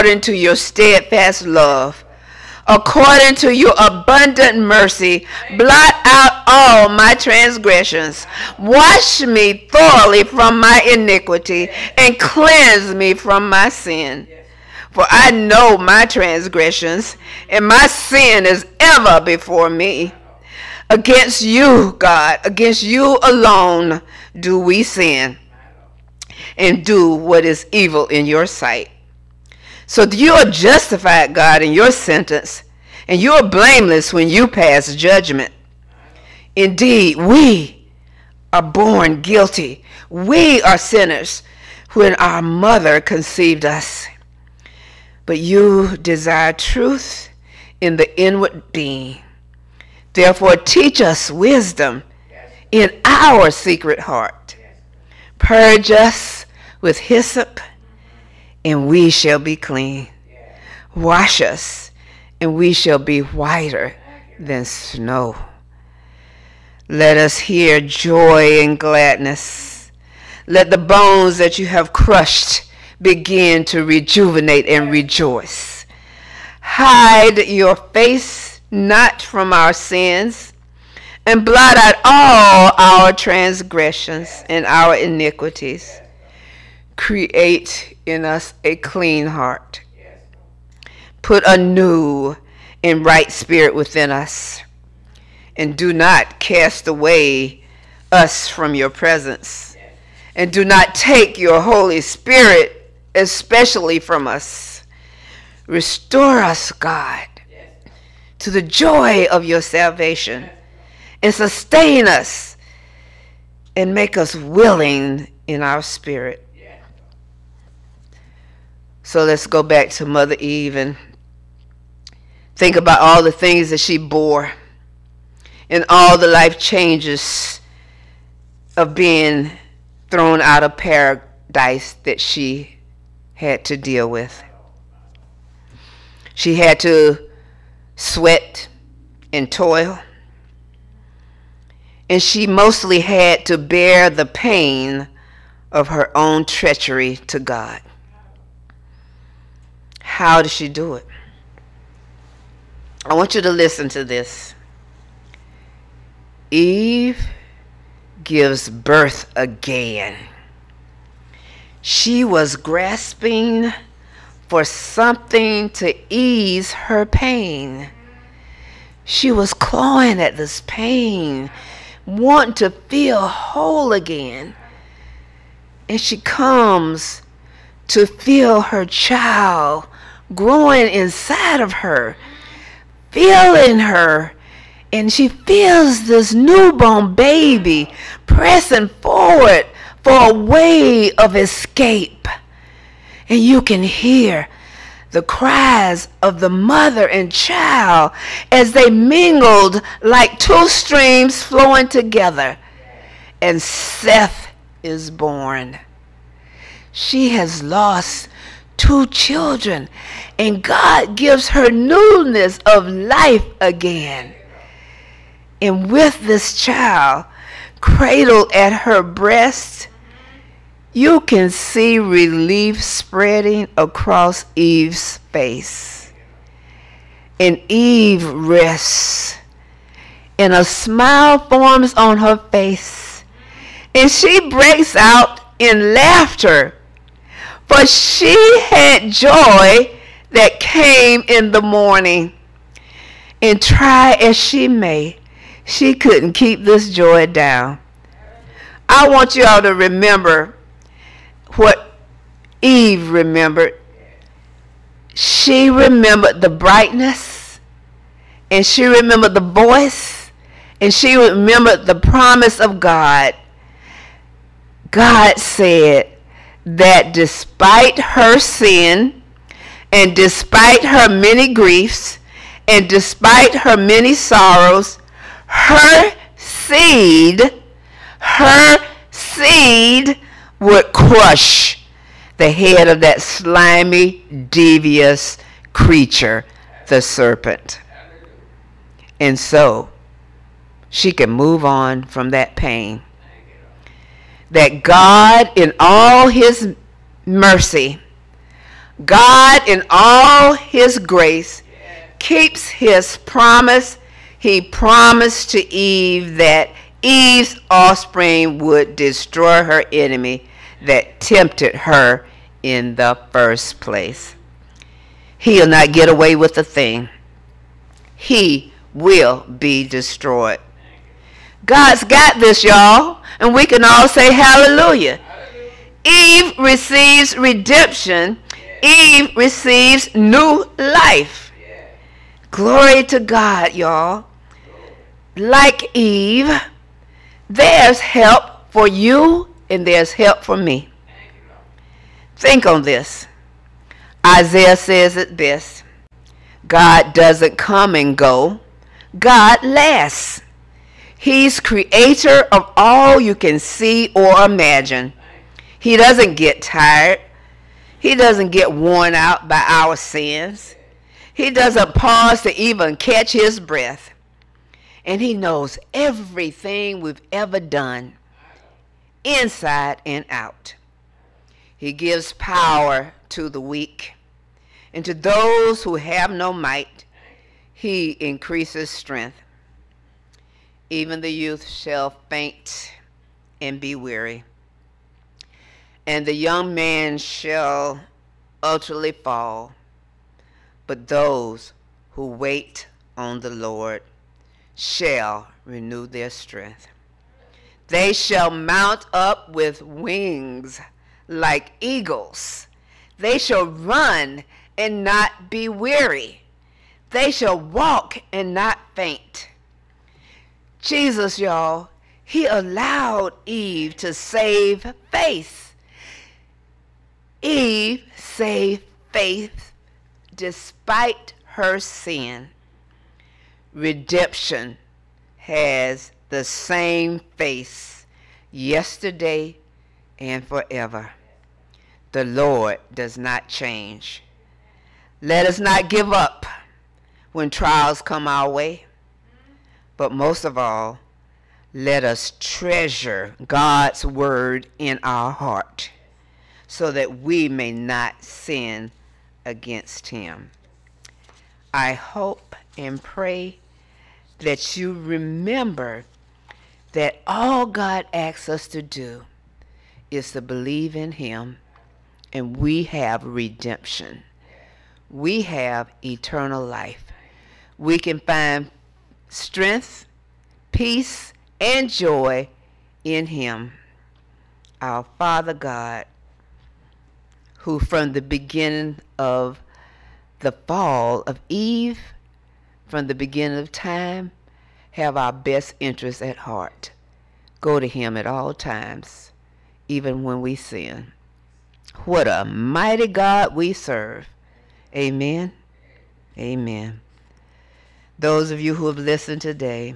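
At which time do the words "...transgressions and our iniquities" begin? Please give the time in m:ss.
1:23.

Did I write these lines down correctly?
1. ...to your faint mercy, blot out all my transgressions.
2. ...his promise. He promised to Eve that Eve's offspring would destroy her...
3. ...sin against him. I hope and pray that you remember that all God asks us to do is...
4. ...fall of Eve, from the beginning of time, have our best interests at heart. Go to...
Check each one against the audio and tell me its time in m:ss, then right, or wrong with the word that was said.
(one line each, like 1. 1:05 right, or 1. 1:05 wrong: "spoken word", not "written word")
1. 0:03 wrong: "abundant", not "faint"
2. 5:02 right
3. 7:28 right
4. 8:00 right.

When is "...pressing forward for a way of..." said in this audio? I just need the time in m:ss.
3:08.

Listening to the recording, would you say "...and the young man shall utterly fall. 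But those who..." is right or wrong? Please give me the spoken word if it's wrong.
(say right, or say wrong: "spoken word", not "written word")
right.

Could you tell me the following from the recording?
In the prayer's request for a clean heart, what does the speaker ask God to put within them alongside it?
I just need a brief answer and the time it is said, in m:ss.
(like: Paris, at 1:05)
A new and right spirit, at 1:31.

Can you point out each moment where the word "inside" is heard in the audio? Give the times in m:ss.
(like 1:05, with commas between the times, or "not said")
3:00, 6:09.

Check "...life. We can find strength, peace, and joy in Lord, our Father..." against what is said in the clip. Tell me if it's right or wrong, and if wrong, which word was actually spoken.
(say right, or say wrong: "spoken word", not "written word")
wrong: "Him", not "Lord".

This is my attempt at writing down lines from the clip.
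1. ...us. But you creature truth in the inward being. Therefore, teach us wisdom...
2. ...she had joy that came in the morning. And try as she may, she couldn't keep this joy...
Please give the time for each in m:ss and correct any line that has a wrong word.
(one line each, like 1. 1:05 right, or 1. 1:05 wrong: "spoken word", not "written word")
1. 0:43 wrong: "desire", not "creature"
2. 3:57 right.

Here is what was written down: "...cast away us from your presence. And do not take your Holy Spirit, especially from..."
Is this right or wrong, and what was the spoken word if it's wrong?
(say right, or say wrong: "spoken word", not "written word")
right.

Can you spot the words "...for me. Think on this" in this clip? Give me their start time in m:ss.
5:40.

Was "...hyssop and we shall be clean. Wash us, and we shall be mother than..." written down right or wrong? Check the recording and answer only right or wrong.
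wrong.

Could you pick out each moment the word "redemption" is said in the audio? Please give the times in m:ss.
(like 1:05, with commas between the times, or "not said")
5:27, 7:03, 7:43.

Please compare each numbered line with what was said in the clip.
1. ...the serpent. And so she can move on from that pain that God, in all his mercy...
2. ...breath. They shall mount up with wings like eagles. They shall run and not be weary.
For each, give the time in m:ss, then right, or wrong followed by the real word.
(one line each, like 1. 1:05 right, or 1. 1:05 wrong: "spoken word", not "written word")
1. 4:46 right
2. 6:36 wrong: "strength", not "breath".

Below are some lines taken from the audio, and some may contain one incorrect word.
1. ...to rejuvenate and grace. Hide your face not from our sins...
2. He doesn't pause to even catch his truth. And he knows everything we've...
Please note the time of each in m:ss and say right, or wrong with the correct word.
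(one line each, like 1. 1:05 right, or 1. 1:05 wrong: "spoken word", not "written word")
1. 1:13 wrong: "rejoice", not "grace"
2. 6:01 wrong: "breath", not "truth".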